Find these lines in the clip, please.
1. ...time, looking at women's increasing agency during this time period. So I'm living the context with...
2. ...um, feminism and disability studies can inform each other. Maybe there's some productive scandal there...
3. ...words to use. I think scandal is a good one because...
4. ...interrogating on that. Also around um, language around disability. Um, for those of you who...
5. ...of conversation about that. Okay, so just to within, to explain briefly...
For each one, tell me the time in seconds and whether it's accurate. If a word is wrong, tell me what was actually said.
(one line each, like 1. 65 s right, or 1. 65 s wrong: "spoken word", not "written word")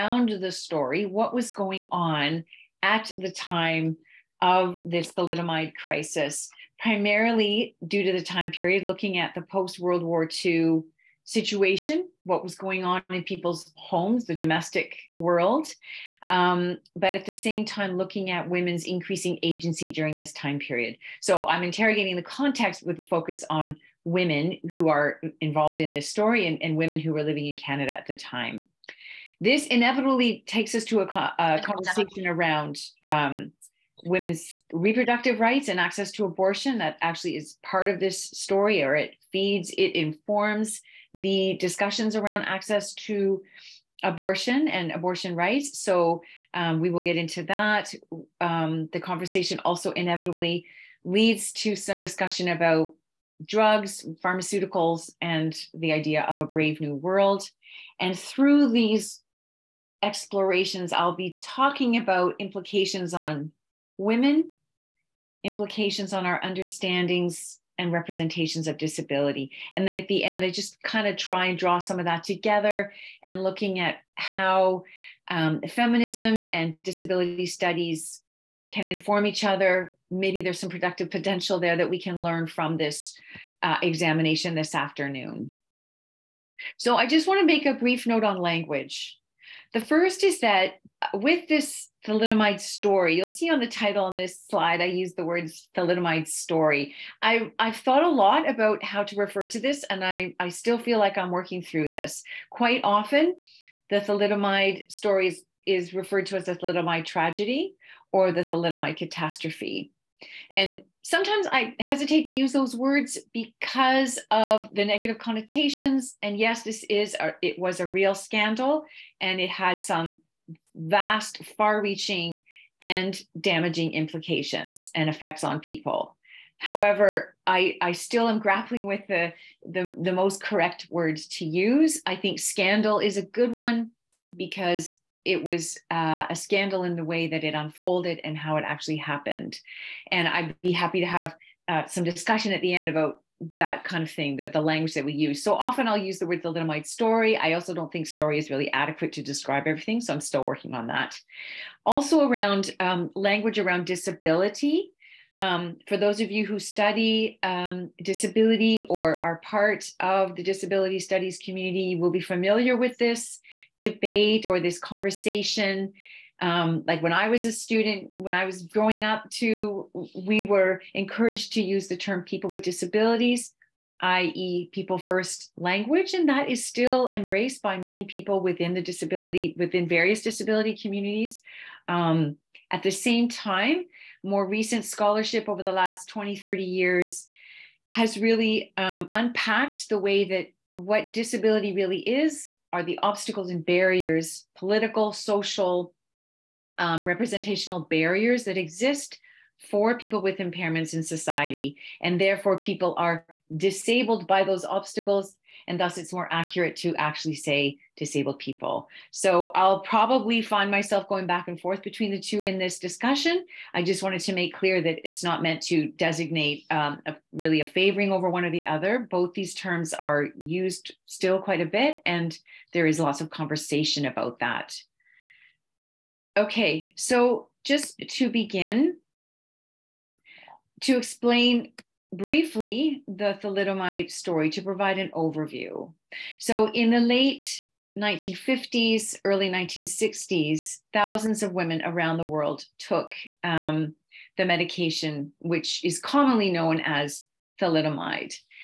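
1. 17 s wrong: "interrogating", not "living"
2. 75 s wrong: "potential", not "scandal"
3. 130 s right
4. 150 s wrong: "working", not "interrogating"
5. 223 s wrong: "begin", not "within".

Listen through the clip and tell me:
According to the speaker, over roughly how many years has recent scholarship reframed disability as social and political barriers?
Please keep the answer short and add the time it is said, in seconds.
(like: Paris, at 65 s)
20 to 30 years, at 186 s.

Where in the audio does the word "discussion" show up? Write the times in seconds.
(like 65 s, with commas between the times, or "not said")
41 s, 51 s, 142 s, 212 s.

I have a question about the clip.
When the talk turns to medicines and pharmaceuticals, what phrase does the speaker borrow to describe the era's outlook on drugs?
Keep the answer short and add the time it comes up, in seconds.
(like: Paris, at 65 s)
brave new world, at 56 s.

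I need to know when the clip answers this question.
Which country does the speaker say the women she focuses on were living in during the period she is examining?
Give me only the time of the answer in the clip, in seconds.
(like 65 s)
27 s.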